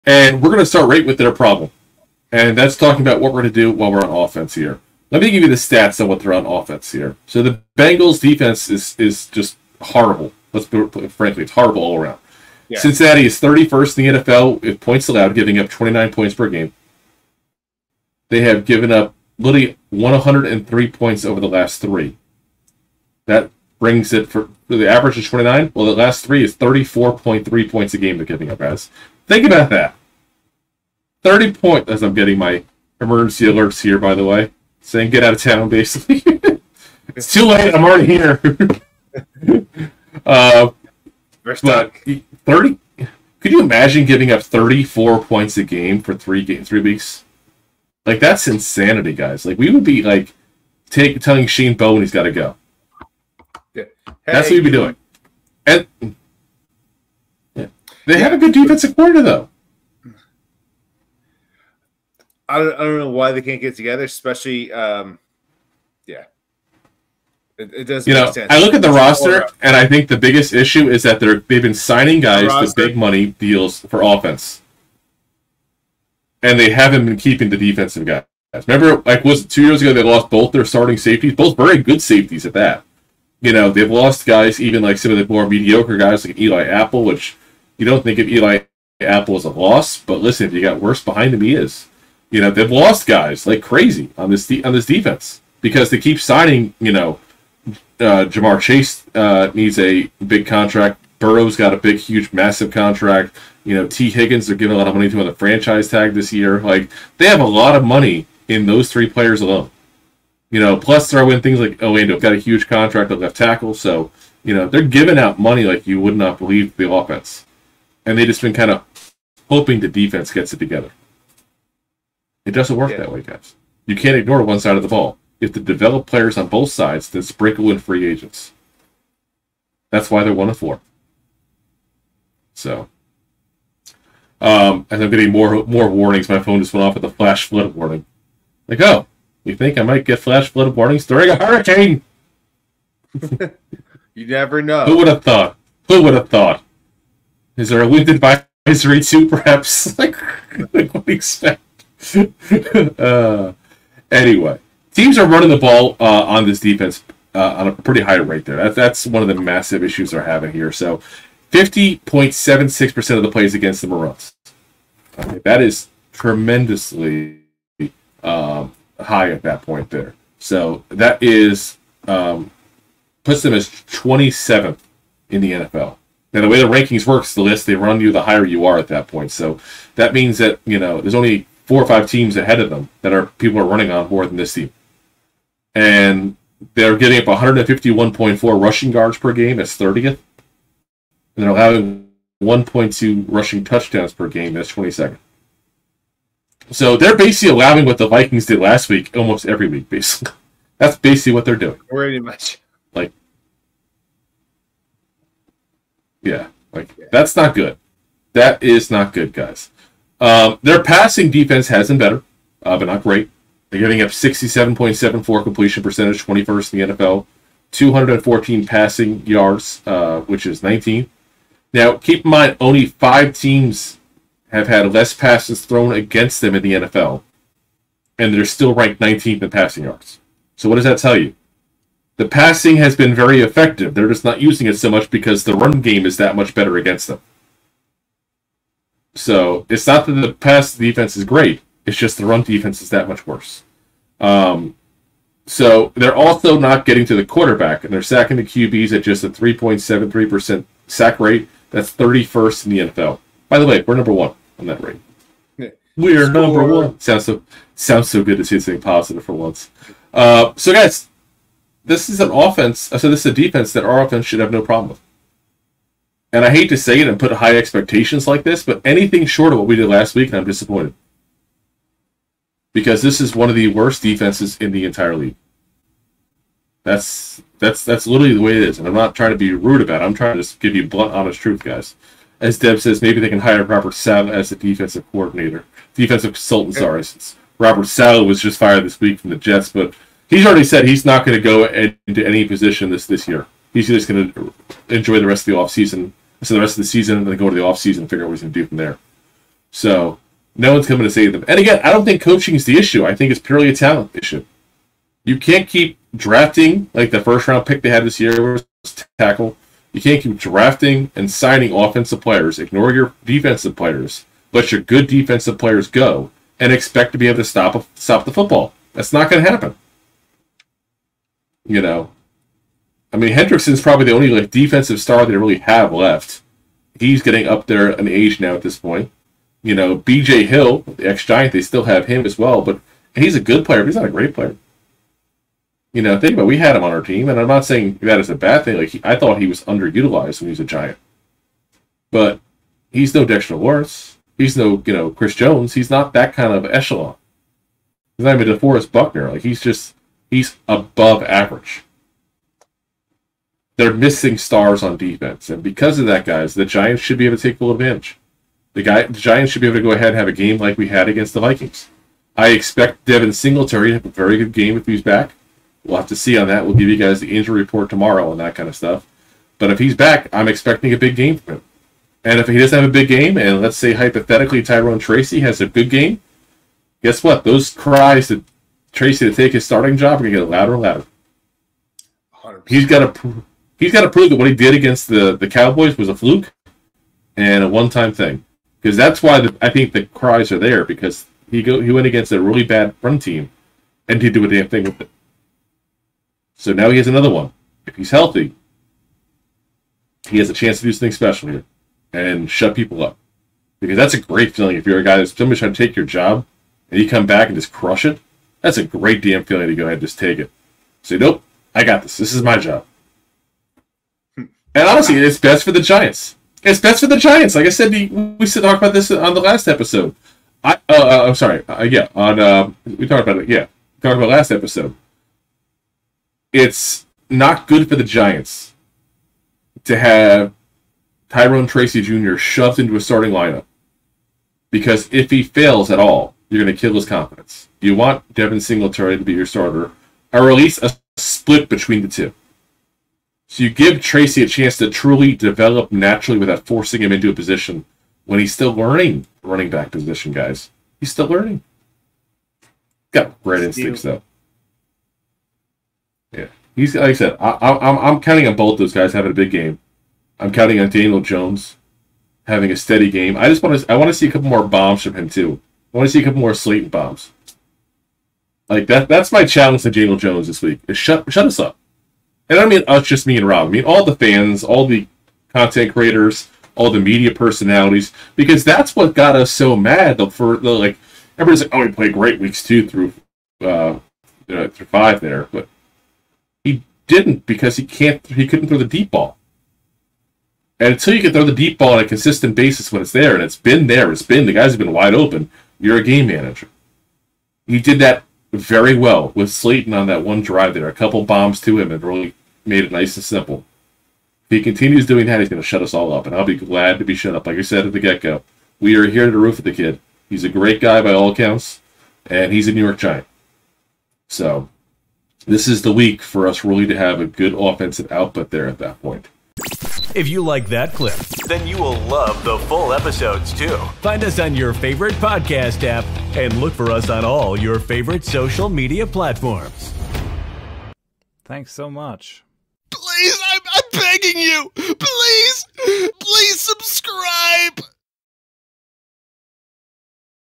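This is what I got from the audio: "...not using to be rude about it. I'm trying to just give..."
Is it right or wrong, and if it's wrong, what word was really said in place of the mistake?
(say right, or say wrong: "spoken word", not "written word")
wrong: "trying", not "using".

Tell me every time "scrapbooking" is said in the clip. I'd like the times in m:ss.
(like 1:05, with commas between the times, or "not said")
not said.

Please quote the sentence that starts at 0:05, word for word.
Let me give you the stats on what they're on offense here.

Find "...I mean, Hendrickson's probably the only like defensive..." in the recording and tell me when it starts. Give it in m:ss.
5:23.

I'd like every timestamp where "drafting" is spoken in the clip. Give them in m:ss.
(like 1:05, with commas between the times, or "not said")
5:06, 5:10.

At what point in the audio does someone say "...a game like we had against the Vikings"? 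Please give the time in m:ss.
6:00.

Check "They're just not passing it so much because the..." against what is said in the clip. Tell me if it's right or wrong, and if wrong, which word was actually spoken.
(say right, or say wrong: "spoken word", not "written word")
wrong: "using", not "passing".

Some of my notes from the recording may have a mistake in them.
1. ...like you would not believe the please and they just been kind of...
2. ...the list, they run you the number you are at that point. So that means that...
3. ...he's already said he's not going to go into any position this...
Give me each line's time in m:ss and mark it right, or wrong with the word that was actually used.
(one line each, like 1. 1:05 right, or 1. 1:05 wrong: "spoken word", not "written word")
1. 1:55 wrong: "offense", not "please"
2. 2:57 wrong: "higher", not "number"
3. 4:50 right.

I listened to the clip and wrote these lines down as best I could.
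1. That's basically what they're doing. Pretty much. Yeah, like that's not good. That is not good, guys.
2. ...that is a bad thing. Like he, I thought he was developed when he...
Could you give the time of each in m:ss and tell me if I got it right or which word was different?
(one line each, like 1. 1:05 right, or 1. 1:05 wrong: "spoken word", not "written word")
1. 3:20 right
2. 5:38 wrong: "underutilized", not "developed".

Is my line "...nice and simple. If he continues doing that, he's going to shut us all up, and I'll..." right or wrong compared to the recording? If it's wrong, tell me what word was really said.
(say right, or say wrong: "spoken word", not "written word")
right.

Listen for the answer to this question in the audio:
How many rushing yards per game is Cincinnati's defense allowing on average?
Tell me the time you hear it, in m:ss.
3:07.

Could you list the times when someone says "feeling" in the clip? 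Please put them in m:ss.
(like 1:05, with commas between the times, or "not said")
6:44, 6:49.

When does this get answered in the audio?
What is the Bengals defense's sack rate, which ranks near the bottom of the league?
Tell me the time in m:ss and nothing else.
4:09.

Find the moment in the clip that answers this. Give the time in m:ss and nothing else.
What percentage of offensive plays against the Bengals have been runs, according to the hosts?
2:41.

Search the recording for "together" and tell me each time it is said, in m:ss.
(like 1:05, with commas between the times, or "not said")
1:03, 2:00.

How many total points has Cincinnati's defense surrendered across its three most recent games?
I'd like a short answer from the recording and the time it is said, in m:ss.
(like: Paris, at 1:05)
103, at 0:19.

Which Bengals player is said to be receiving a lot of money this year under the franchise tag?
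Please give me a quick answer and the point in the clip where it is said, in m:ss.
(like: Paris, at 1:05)
Tee Higgins, at 1:43.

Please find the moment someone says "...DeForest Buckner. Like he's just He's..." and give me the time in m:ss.
5:48.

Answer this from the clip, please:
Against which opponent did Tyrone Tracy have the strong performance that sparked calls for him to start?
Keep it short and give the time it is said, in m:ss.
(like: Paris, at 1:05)
Cowboys, at 6:25.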